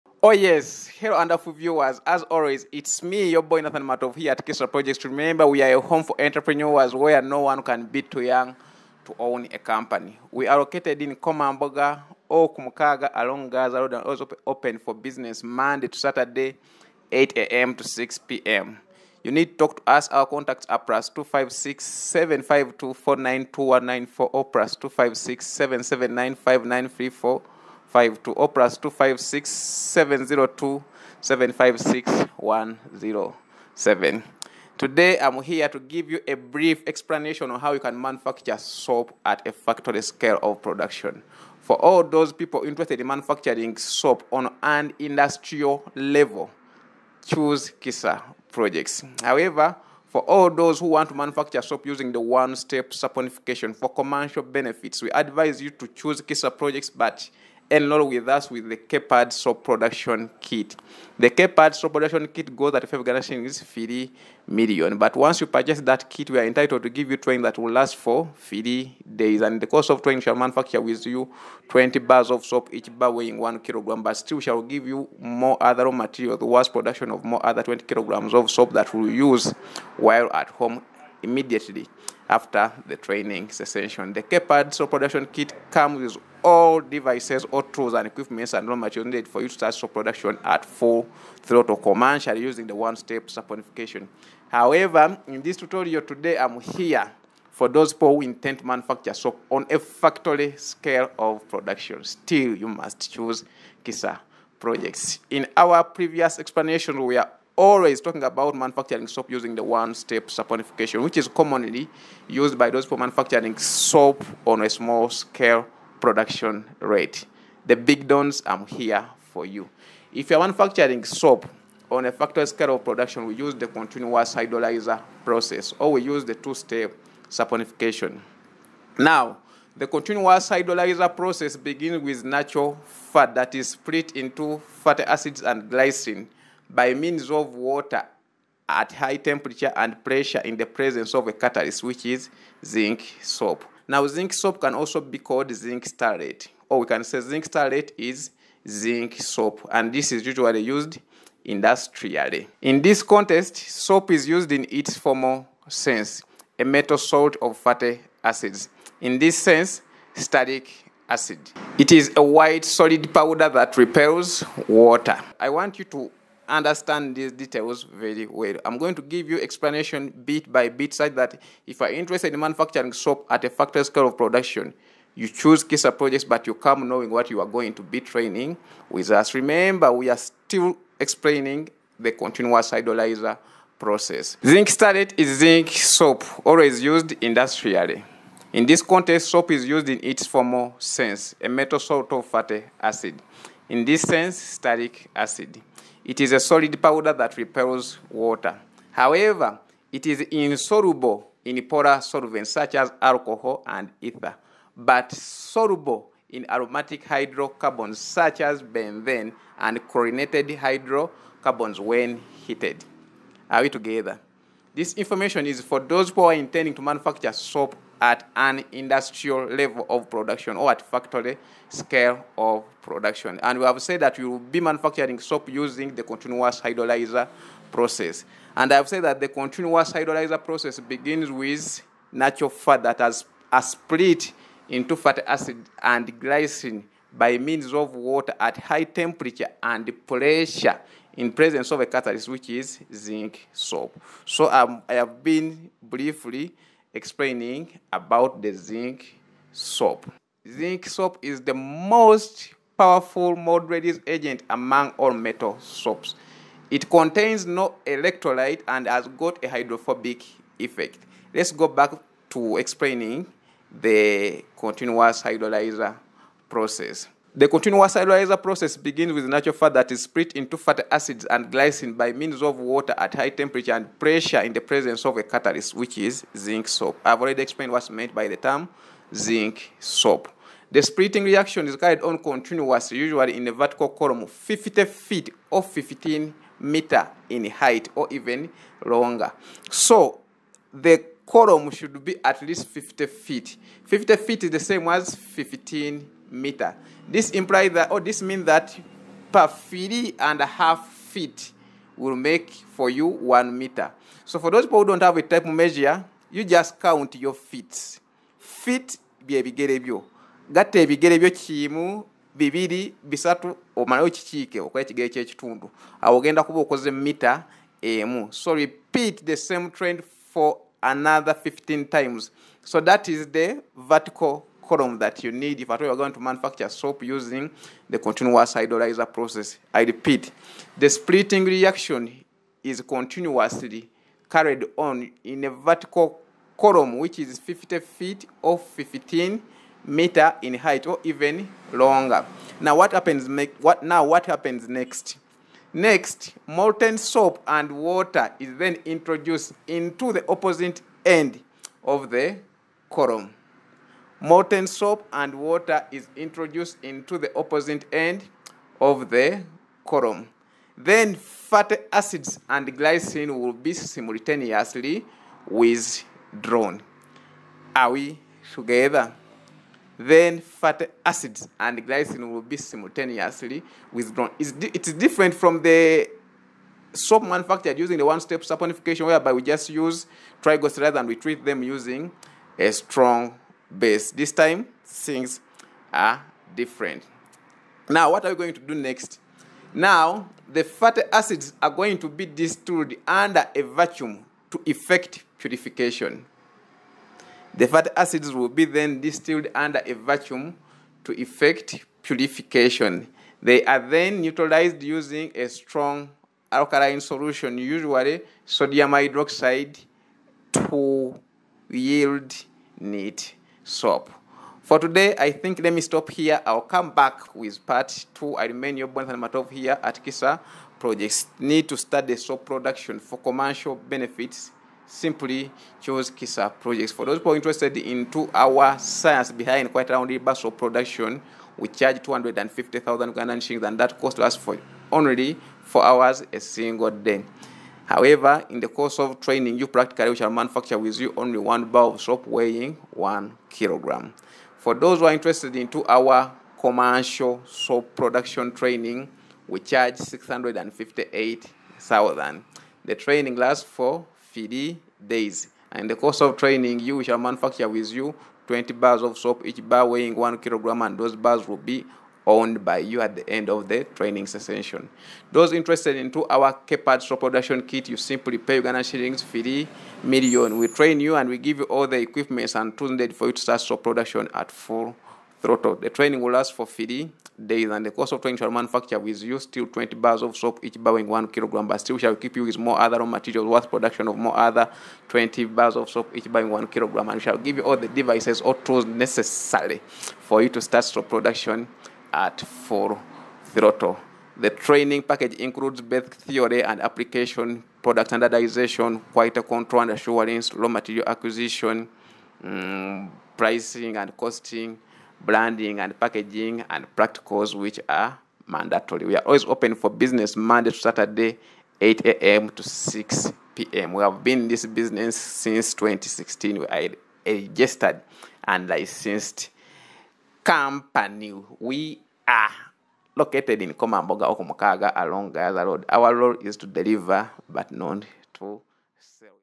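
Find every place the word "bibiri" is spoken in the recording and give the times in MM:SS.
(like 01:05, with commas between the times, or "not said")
05:12.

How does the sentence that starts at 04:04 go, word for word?
So um, I have been briefly explaining about the zinc soap.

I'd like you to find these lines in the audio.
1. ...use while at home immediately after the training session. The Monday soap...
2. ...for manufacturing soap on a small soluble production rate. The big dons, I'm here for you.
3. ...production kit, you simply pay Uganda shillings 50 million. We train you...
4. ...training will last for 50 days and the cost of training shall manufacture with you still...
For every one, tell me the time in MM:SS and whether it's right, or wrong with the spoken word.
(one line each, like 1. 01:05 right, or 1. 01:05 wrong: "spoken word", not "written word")
1. 01:19 wrong: "KPAD", not "Monday"
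2. 01:52 wrong: "scale", not "soluble"
3. 07:47 right
4. 07:55 right.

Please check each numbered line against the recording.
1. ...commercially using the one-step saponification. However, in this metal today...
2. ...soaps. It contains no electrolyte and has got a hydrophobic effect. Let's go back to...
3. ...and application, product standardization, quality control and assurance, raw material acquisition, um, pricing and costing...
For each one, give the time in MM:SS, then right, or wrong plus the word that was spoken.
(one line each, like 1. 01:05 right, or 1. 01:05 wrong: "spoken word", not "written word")
1. 01:31 wrong: "tutorial", not "metal"
2. 04:15 right
3. 08:16 right.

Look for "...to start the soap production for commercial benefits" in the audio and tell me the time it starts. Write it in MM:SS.
07:01.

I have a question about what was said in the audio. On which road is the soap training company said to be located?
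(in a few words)
Gayaza Road.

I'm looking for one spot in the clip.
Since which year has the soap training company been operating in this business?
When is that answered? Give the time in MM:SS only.
08:35.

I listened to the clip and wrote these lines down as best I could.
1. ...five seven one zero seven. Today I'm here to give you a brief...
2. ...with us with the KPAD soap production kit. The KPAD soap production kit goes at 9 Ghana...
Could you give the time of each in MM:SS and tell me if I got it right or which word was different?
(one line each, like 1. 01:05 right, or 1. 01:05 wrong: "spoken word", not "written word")
1. 00:31 wrong: "six", not "seven"
2. 00:58 wrong: "5", not "9".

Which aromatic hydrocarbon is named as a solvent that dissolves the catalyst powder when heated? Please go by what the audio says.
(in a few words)
benzene.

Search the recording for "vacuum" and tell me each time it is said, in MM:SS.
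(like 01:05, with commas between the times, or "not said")
06:33, 06:39.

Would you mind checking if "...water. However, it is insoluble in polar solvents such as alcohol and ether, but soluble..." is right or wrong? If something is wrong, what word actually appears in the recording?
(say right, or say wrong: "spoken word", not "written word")
right.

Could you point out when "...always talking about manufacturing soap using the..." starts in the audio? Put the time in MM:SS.
01:47.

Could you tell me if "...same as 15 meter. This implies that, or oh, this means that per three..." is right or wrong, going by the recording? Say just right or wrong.
right.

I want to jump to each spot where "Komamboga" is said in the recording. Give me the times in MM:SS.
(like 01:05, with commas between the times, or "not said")
00:11, 08:43.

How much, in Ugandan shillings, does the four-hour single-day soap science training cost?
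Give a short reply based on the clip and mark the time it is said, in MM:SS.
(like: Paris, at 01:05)
250,000, at 07:12.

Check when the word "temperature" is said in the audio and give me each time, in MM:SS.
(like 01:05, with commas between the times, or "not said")
02:19, 03:58, 04:33.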